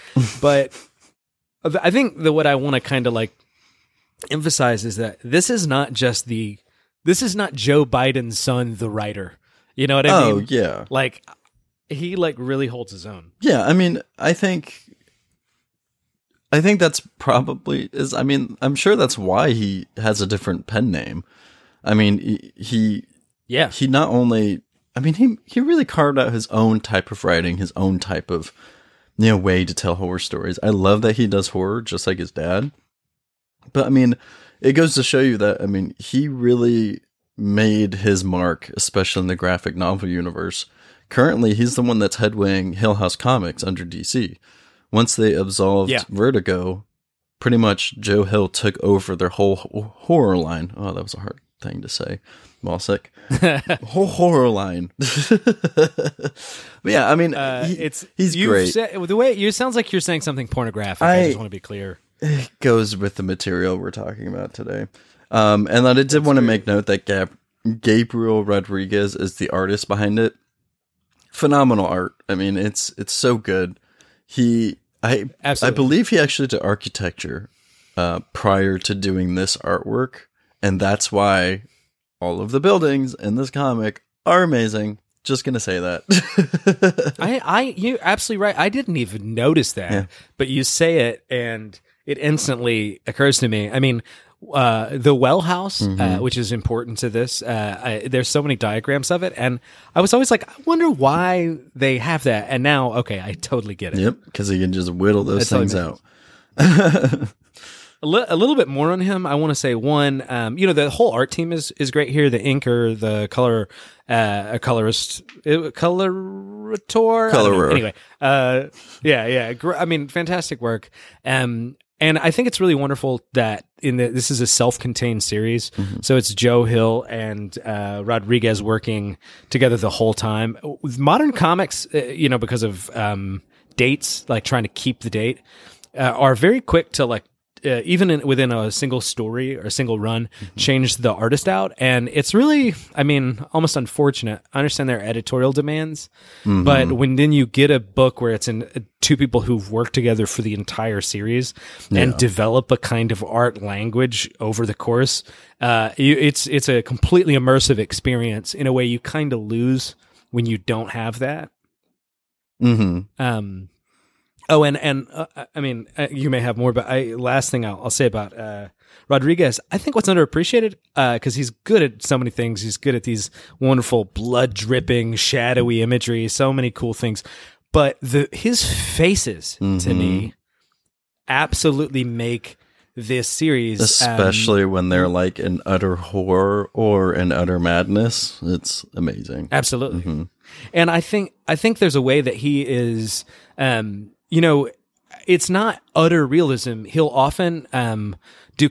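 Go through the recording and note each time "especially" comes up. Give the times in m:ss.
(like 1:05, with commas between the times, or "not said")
0:38, 3:04.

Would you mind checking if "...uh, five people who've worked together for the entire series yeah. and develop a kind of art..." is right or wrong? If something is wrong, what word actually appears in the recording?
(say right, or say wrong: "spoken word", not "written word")
wrong: "two", not "five".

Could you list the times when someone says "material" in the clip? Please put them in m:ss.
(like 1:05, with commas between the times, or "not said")
1:03.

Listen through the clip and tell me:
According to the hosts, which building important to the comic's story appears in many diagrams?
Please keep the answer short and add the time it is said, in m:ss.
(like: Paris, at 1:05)
The well house, at 1:34.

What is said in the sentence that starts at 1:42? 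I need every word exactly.
And now, okay, I totally get it.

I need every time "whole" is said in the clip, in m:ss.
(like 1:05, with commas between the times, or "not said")
0:49, 0:53, 1:50, 2:09.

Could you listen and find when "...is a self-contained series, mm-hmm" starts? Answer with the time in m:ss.
2:04.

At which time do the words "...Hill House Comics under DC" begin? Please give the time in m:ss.
0:42.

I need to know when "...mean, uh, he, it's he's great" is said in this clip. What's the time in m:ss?
0:57.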